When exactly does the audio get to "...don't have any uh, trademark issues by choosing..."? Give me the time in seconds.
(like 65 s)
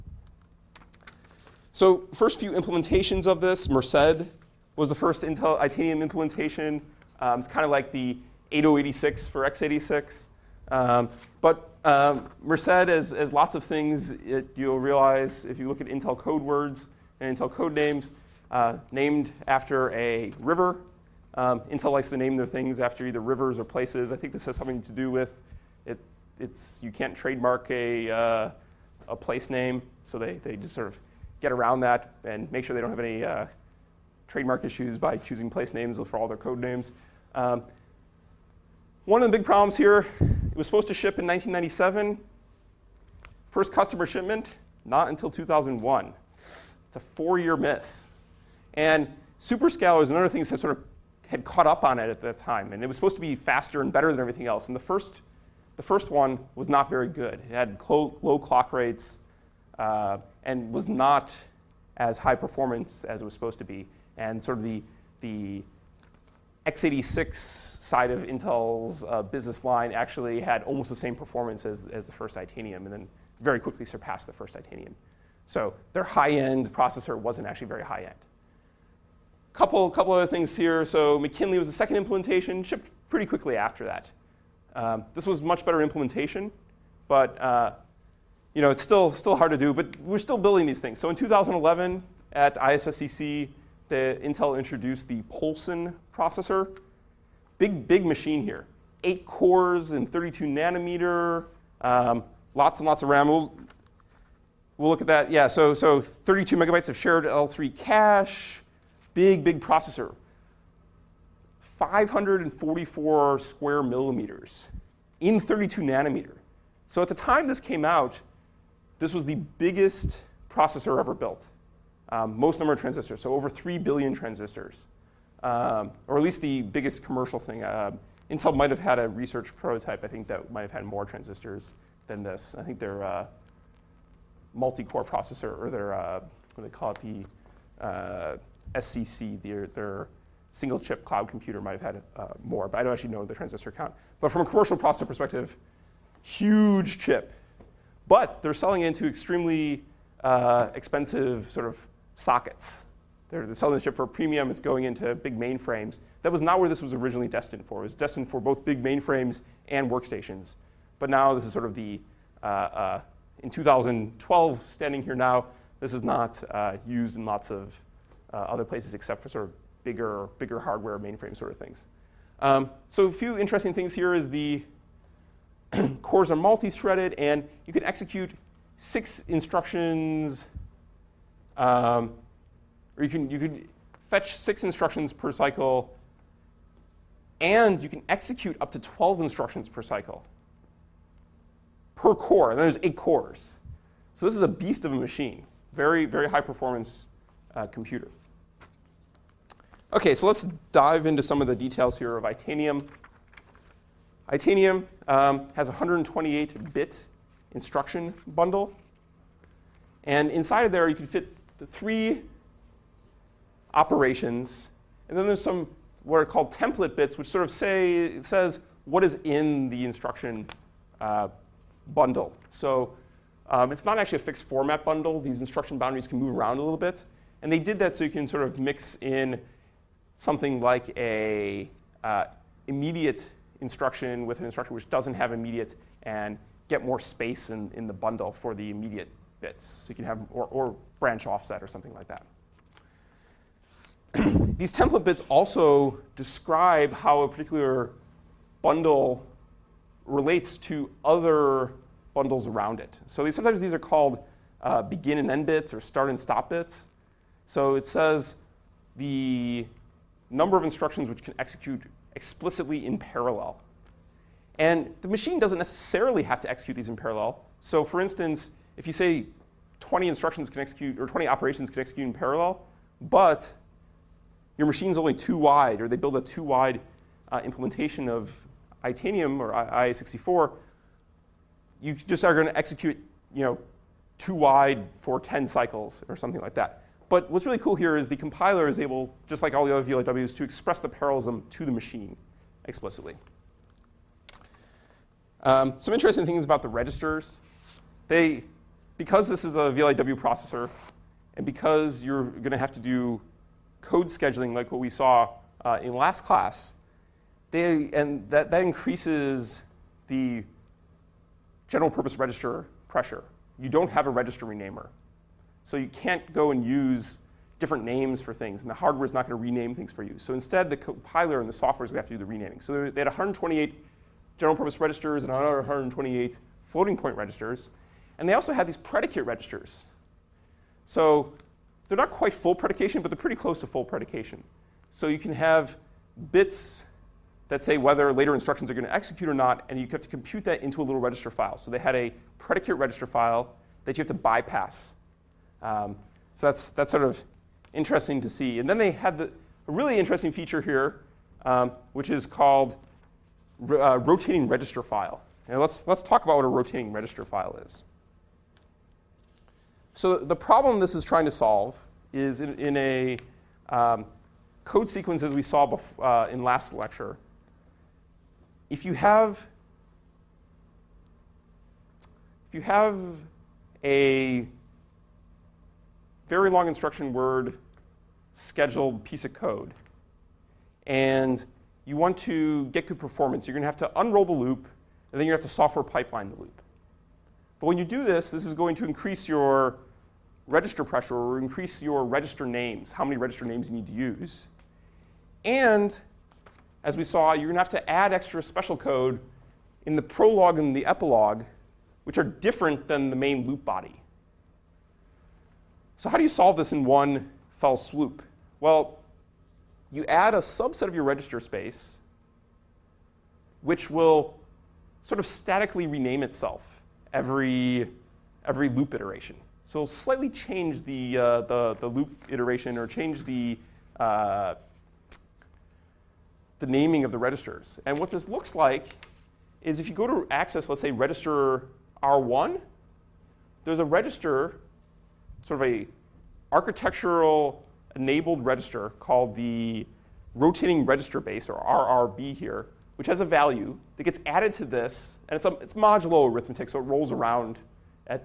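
32 s.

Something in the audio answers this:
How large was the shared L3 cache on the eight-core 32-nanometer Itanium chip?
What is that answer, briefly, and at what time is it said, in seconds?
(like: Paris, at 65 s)
32 megabytes, at 105 s.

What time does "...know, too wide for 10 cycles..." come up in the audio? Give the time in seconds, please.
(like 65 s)
283 s.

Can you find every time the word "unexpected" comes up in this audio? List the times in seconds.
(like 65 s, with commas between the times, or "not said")
not said.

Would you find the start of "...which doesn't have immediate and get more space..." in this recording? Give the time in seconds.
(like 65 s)
234 s.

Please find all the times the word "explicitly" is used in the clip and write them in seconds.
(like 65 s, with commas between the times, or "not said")
262 s, 292 s.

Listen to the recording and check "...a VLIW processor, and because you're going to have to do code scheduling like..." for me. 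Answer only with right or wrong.
right.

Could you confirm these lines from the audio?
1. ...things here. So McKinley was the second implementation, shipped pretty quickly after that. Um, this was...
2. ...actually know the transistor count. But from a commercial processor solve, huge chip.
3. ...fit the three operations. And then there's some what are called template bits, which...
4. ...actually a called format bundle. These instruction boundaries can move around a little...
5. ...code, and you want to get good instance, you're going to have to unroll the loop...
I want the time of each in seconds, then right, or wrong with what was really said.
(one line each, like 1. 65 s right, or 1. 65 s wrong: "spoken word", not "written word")
1. 80 s right
2. 142 s wrong: "perspective", not "solve"
3. 211 s right
4. 223 s wrong: "fixed", not "called"
5. 379 s wrong: "performance", not "instance".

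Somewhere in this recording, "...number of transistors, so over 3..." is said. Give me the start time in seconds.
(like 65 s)
122 s.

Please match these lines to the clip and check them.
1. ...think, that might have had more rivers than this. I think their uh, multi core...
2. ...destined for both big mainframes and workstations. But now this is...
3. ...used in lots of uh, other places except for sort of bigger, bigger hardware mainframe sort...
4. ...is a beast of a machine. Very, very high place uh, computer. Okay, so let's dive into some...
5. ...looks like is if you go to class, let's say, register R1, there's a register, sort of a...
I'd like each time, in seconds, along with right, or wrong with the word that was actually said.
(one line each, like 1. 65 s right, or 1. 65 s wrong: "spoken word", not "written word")
1. 130 s wrong: "transistors", not "rivers"
2. 157 s right
3. 166 s right
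4. 194 s wrong: "performance", not "place"
5. 428 s wrong: "access", not "class".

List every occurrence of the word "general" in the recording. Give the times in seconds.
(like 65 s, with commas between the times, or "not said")
311 s, 324 s.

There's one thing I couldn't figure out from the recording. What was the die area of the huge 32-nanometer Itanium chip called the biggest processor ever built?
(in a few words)
544 square millimeters.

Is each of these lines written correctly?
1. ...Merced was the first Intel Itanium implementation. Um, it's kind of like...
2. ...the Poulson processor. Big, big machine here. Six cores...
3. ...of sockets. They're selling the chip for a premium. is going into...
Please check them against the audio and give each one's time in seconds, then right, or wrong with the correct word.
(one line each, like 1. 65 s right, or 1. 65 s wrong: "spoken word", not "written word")
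1. 3 s right
2. 95 s wrong: "Eight", not "Six"
3. 151 s right.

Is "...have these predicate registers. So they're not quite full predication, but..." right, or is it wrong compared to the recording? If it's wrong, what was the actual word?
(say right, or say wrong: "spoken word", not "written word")
right.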